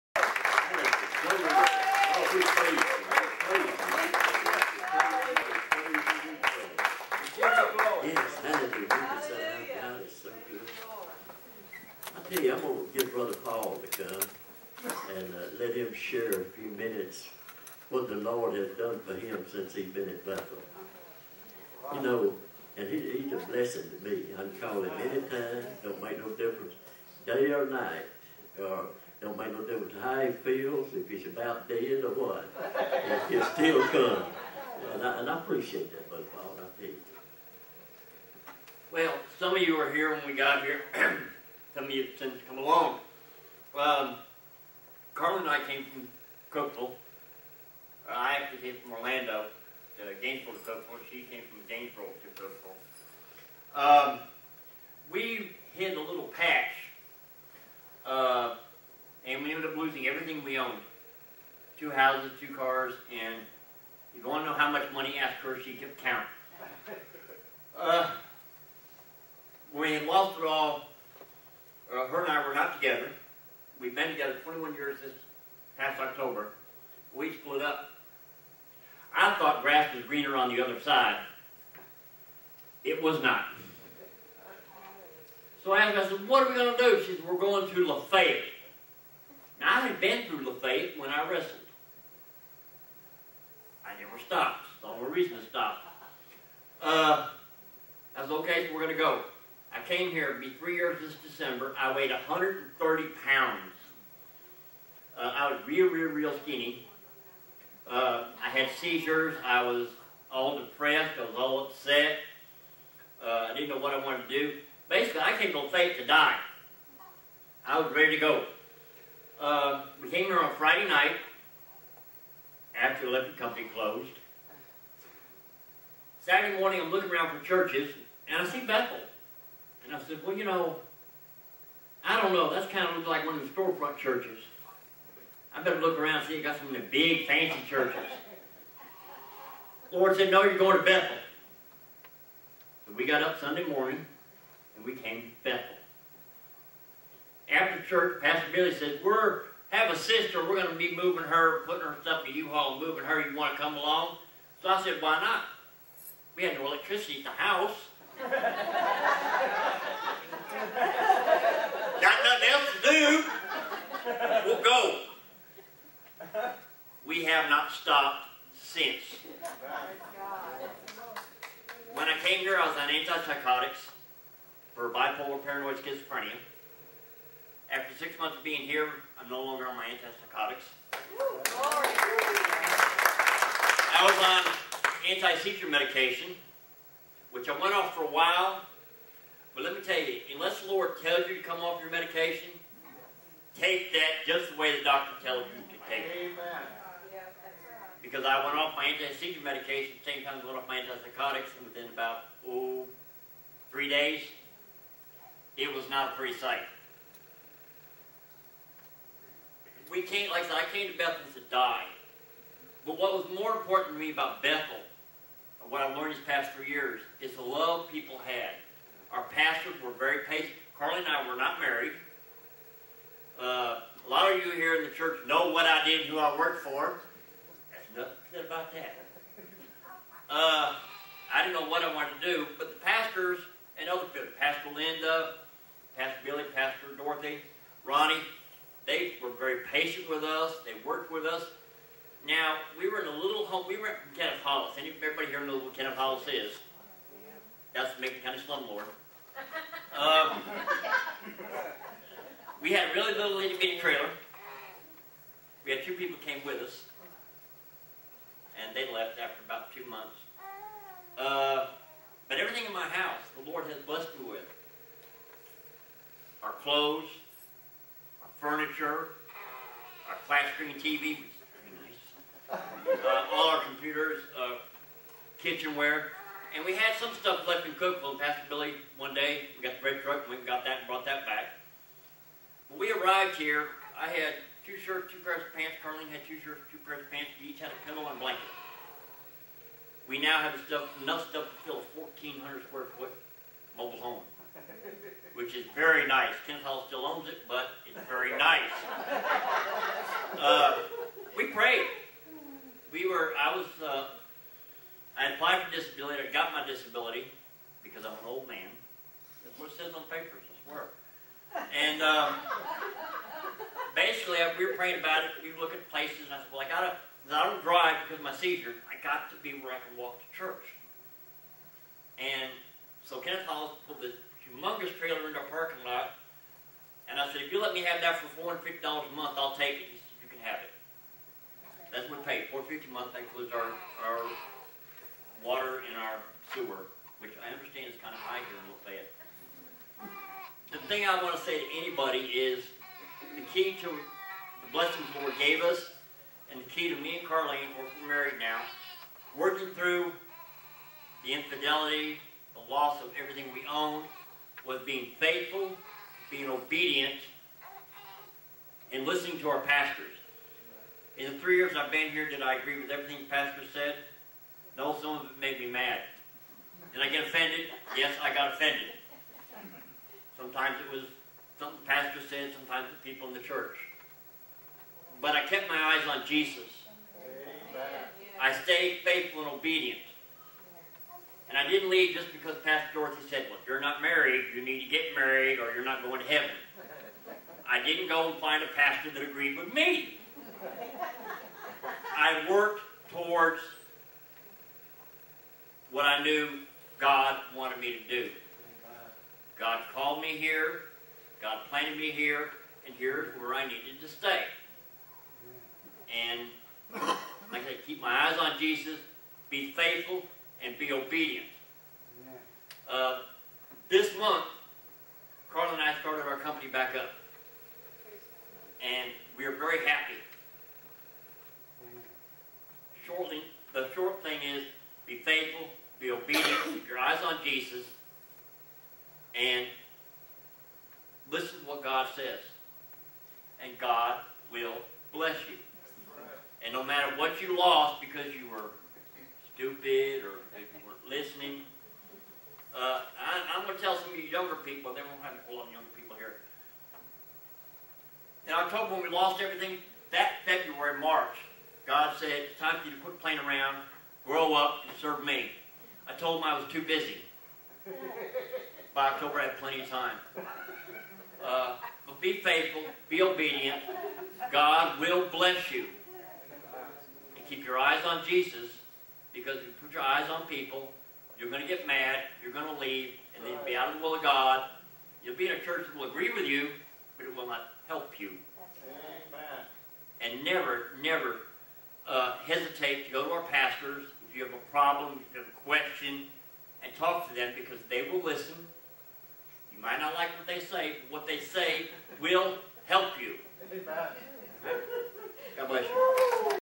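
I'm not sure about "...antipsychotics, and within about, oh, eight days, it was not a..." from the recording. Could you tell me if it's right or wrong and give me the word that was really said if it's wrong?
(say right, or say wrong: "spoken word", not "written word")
wrong: "three", not "eight".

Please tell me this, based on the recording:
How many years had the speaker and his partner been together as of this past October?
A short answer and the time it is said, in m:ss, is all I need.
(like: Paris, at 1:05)
21, at 1:14.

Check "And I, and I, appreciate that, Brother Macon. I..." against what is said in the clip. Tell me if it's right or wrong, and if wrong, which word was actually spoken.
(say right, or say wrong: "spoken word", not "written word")
wrong: "Paul", not "Macon".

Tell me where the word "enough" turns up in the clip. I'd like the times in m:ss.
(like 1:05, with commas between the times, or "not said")
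4:51.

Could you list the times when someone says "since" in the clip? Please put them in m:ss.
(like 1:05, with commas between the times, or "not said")
0:19, 0:42, 2:48.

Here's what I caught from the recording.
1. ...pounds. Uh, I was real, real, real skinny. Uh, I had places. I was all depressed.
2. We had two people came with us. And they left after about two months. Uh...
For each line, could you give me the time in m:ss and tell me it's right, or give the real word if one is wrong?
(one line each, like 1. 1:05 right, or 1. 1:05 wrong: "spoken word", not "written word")
1. 1:43 wrong: "seizures", not "places"
2. 4:15 right.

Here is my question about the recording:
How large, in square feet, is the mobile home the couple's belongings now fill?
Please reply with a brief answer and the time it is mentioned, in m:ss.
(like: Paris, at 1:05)
1,400, at 4:51.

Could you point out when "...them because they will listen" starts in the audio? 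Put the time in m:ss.
8:07.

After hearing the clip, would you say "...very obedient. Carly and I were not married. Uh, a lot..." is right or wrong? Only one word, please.
wrong.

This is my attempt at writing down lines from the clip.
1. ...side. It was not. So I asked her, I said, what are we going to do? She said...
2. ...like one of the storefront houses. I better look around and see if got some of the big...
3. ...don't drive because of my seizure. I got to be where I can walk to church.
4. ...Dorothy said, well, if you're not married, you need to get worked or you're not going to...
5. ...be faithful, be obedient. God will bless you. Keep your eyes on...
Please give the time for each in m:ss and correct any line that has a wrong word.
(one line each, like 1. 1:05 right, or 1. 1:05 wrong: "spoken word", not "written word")
1. 1:20 right
2. 2:13 wrong: "churches", not "houses"
3. 5:17 right
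4. 6:22 wrong: "married", not "worked"
5. 7:42 right.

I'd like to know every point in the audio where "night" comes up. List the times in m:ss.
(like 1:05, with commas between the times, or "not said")
0:27, 2:00.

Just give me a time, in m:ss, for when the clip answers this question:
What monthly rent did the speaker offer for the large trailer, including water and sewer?
5:28.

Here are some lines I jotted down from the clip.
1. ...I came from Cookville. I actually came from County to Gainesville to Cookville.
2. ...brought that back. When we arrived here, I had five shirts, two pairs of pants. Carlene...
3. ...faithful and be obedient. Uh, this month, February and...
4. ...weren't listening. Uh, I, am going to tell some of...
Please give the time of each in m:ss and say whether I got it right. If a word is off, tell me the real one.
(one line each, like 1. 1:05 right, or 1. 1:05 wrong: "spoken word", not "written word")
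1. 0:45 wrong: "Orlando", not "County"
2. 4:40 wrong: "two", not "five"
3. 6:49 wrong: "Carl", not "February"
4. 7:20 right.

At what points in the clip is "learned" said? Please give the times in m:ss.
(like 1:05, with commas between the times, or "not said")
3:35.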